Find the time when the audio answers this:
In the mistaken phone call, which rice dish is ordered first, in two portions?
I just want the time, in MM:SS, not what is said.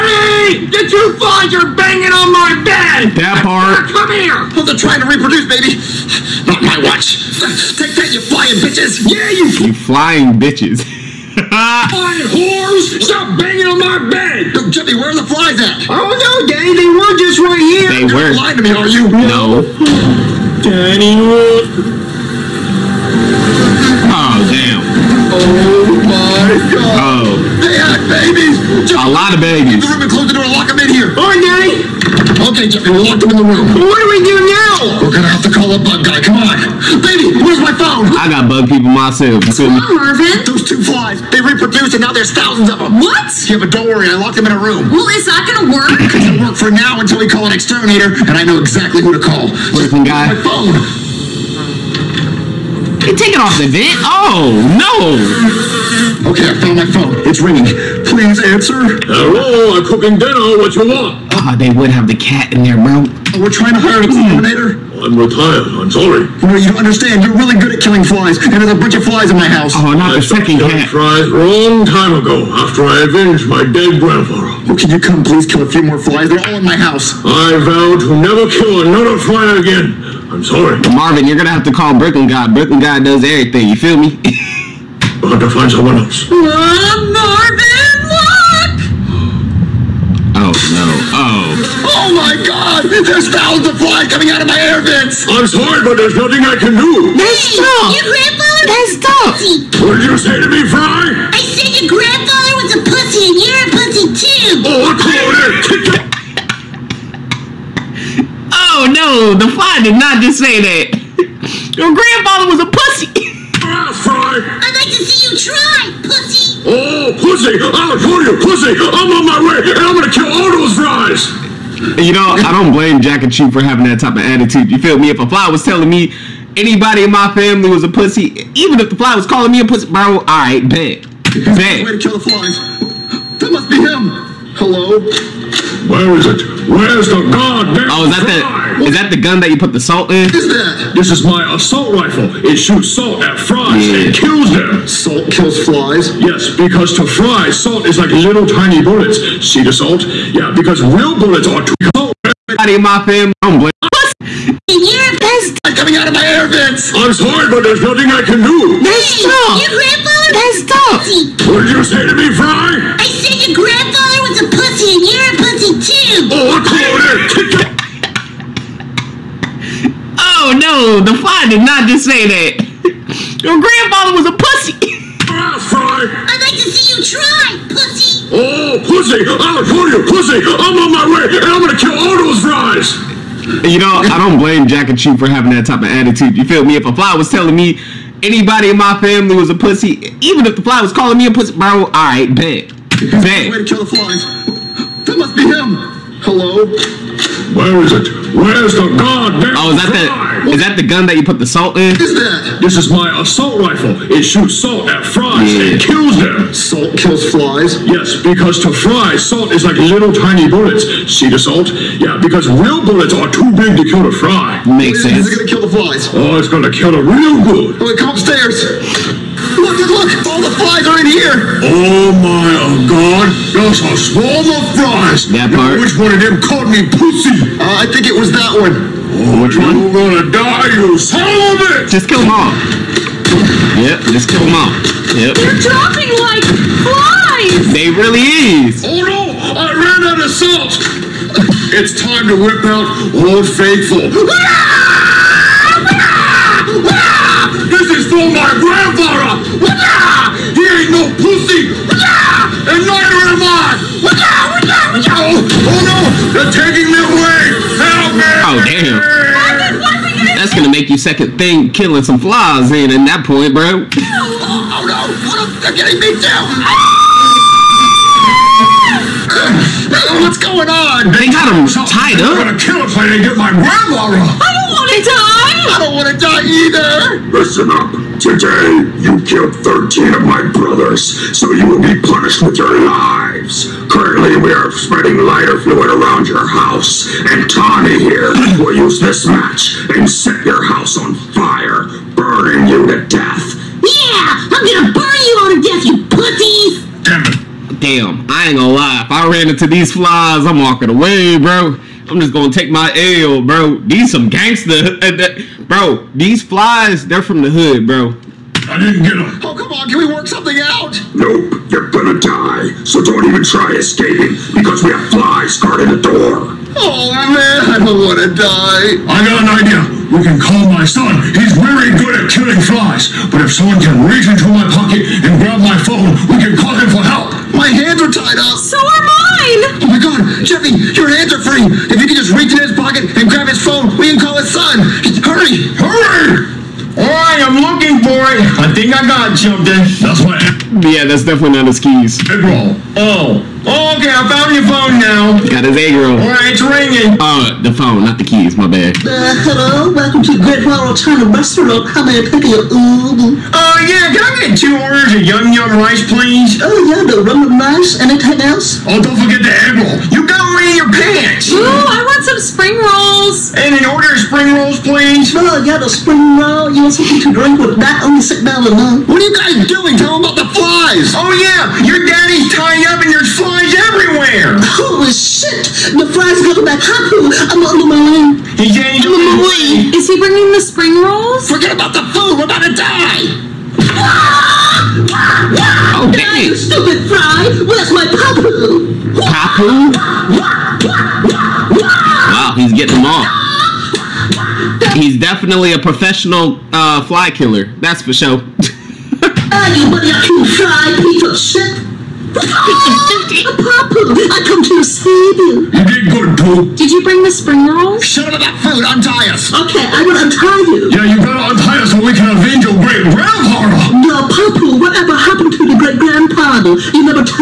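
05:55.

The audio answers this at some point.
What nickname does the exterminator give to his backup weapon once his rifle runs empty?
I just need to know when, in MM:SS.
04:03.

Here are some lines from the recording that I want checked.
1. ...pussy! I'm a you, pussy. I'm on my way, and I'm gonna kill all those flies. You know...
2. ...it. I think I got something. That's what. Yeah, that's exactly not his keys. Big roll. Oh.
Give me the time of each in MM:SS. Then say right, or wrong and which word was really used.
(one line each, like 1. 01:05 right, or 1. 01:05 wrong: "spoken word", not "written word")
1. 02:58 right
2. 05:38 wrong: "definitely", not "exactly".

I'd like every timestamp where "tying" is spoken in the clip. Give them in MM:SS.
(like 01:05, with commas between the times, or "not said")
06:12.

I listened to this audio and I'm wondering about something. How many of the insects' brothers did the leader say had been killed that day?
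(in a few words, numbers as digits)
13.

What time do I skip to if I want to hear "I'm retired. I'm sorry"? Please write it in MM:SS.
01:05.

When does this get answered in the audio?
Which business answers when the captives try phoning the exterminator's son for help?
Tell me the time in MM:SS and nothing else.
05:50.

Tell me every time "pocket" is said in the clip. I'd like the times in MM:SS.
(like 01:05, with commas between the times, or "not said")
05:24, 05:32.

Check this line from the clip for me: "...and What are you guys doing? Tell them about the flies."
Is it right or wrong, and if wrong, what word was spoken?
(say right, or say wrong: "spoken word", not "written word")
right.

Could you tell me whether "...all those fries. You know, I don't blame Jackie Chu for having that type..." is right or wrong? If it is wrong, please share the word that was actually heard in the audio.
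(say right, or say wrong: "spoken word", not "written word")
right.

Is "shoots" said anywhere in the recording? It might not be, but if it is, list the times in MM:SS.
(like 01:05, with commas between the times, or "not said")
02:22, 03:24.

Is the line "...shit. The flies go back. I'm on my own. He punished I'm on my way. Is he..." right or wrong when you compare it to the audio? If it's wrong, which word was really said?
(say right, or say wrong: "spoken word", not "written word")
wrong: "changed", not "punished".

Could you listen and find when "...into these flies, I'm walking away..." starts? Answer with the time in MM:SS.
04:59.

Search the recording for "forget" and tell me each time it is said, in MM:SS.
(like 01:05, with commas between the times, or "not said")
05:59, 06:21.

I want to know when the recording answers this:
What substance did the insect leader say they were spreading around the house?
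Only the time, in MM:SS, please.
04:45.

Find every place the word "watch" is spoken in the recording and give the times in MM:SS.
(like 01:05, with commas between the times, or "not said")
00:06.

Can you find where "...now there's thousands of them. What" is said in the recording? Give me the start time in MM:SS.
00:42.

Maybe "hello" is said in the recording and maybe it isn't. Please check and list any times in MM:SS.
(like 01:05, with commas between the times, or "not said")
00:59, 02:14, 05:49.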